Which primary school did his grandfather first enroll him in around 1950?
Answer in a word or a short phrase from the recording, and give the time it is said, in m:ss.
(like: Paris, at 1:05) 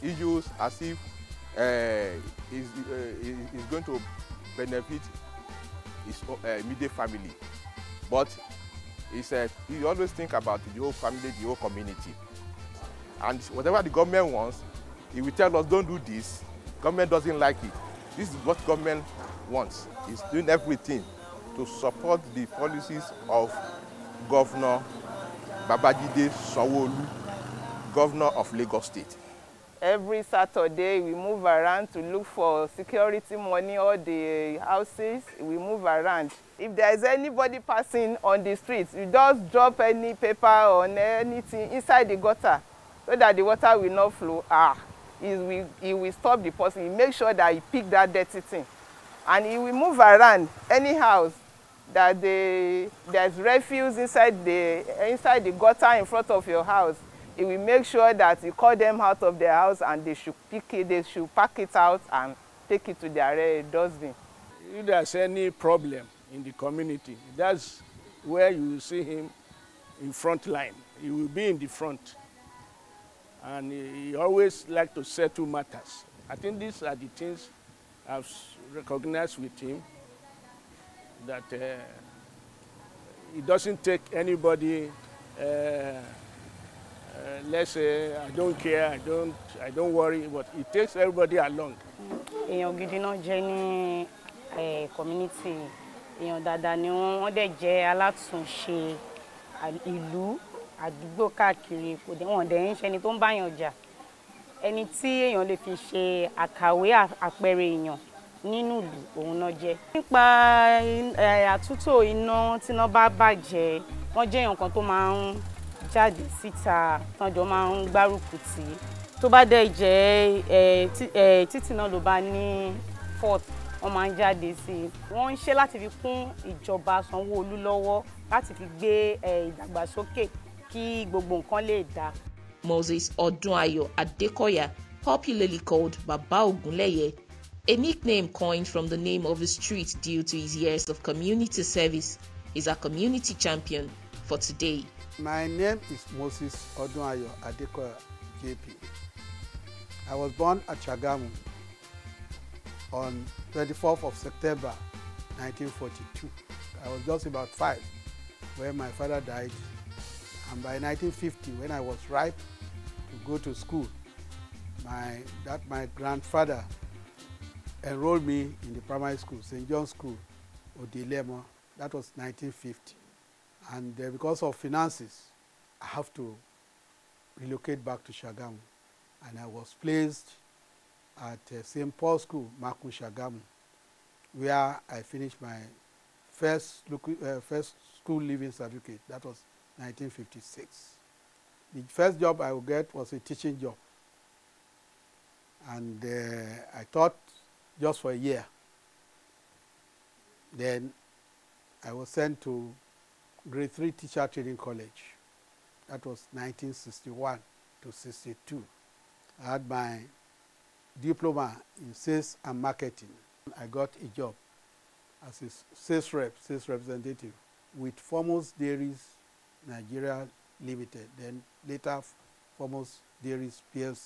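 St. John's School, Odilemo, at 2:49.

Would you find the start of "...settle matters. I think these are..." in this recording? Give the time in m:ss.
1:15.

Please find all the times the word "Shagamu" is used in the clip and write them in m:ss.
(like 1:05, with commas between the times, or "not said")
2:58, 3:02.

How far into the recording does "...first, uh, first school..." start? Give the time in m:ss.
3:06.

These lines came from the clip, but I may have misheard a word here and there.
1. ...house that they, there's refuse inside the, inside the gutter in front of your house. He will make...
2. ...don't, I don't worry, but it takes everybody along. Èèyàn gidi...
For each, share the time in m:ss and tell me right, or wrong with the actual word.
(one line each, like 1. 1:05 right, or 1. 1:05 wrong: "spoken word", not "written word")
1. 0:50 right
2. 1:28 right.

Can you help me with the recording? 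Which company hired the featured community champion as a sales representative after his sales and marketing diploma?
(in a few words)
Foremost Dairies Nigeria Limited.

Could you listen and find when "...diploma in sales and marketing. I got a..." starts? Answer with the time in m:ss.
3:31.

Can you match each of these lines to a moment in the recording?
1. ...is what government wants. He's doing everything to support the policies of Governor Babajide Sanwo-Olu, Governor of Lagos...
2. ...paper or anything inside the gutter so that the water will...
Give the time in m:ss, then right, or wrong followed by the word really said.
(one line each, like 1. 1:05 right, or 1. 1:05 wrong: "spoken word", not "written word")
1. 0:18 right
2. 0:40 right.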